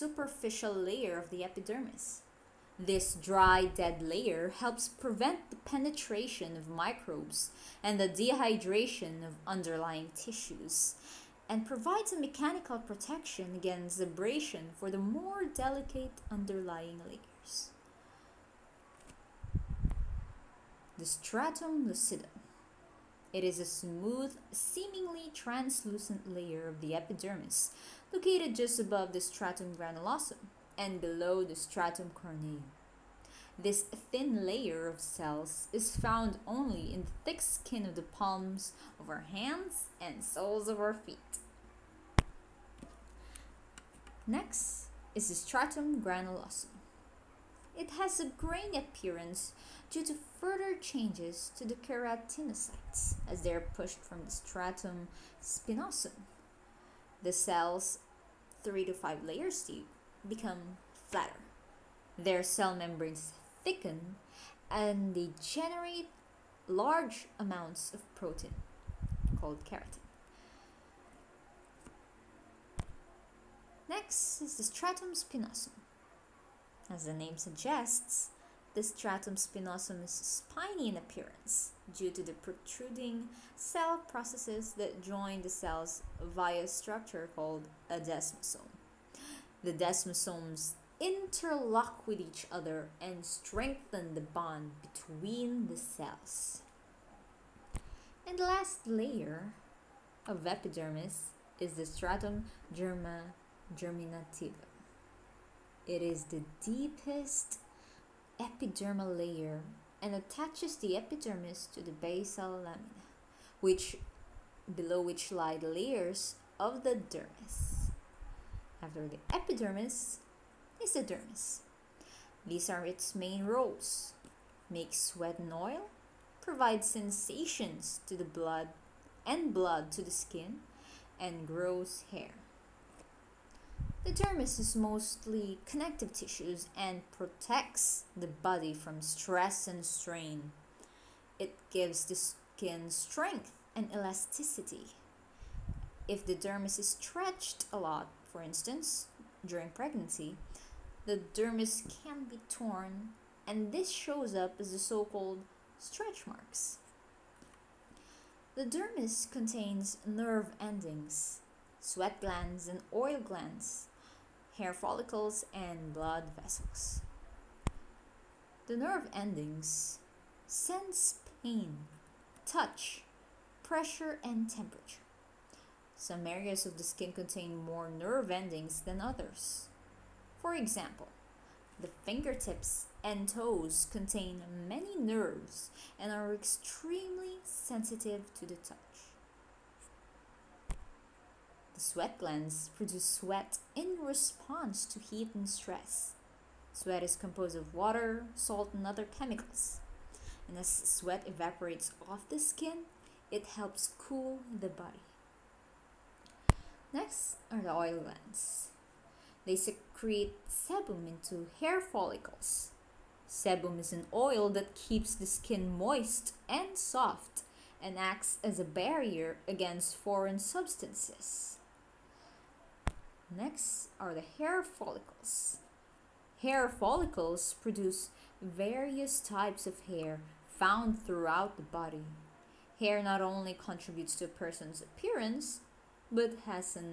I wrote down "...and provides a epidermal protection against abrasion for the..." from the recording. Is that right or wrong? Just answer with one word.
wrong.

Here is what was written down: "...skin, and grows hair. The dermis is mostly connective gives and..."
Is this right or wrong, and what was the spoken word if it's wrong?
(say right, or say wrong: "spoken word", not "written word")
wrong: "tissues", not "gives".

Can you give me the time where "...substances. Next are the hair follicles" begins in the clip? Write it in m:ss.
3:40.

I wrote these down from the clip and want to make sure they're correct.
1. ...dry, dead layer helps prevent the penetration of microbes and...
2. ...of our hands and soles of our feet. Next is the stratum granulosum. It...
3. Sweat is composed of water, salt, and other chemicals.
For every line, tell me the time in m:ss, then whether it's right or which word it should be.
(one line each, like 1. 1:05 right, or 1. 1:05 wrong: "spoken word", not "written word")
1. 0:03 right
2. 0:38 right
3. 3:16 right.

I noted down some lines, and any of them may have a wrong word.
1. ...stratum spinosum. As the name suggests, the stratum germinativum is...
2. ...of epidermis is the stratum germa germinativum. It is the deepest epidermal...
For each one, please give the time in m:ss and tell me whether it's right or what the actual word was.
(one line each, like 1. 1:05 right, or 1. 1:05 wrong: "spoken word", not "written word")
1. 1:14 wrong: "spinosum", not "germinativum"
2. 1:40 right.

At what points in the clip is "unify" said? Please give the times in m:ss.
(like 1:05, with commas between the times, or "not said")
not said.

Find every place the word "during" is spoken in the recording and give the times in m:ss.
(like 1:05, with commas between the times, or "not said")
2:29.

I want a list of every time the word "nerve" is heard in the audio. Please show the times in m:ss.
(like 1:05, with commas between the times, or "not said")
2:40, 2:48, 2:57, 3:04.